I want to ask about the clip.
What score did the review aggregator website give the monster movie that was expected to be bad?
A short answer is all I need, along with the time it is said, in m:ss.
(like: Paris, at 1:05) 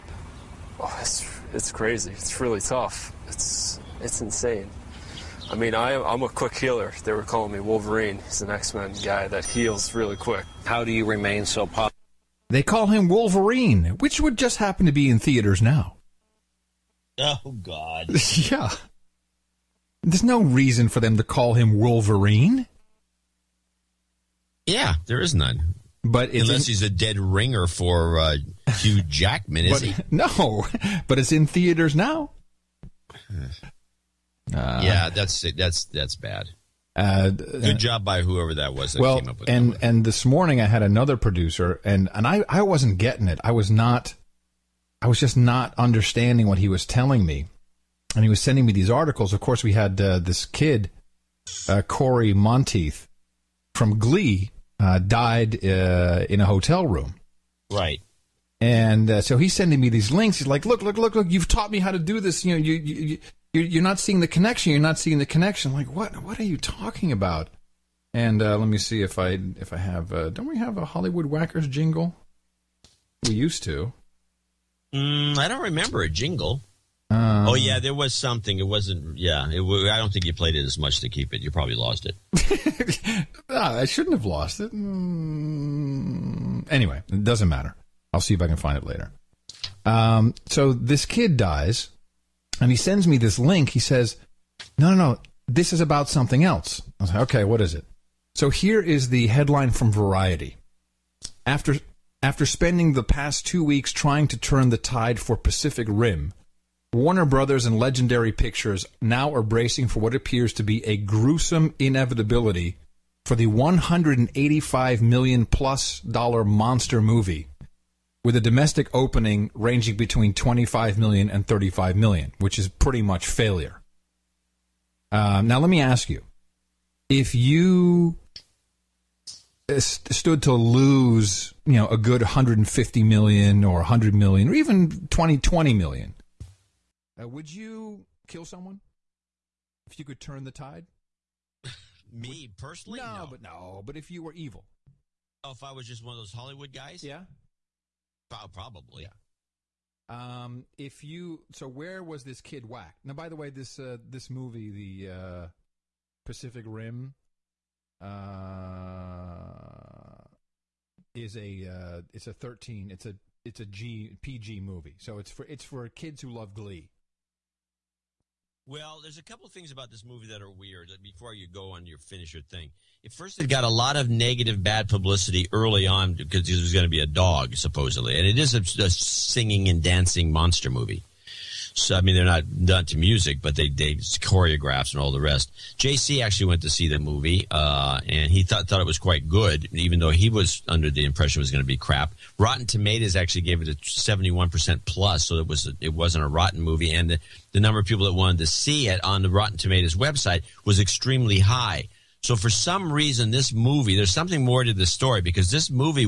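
71%, at 3:13.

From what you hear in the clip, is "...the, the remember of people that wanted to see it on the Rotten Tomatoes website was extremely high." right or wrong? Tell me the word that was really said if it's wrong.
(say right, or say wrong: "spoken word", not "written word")
wrong: "number", not "remember".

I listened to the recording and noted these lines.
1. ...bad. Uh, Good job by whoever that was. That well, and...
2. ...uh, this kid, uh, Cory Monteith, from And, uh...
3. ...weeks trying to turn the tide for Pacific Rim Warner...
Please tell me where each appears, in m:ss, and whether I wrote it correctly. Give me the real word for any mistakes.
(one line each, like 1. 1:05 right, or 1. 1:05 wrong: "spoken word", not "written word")
1. 0:36 right
2. 0:49 wrong: "Glee", not "And"
3. 1:43 right.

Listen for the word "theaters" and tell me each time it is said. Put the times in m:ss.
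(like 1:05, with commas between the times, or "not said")
0:15, 0:31.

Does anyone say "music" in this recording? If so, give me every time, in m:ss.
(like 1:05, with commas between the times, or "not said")
3:02.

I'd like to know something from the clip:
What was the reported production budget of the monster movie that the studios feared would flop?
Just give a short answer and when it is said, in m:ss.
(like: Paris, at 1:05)
$185 million, at 1:53.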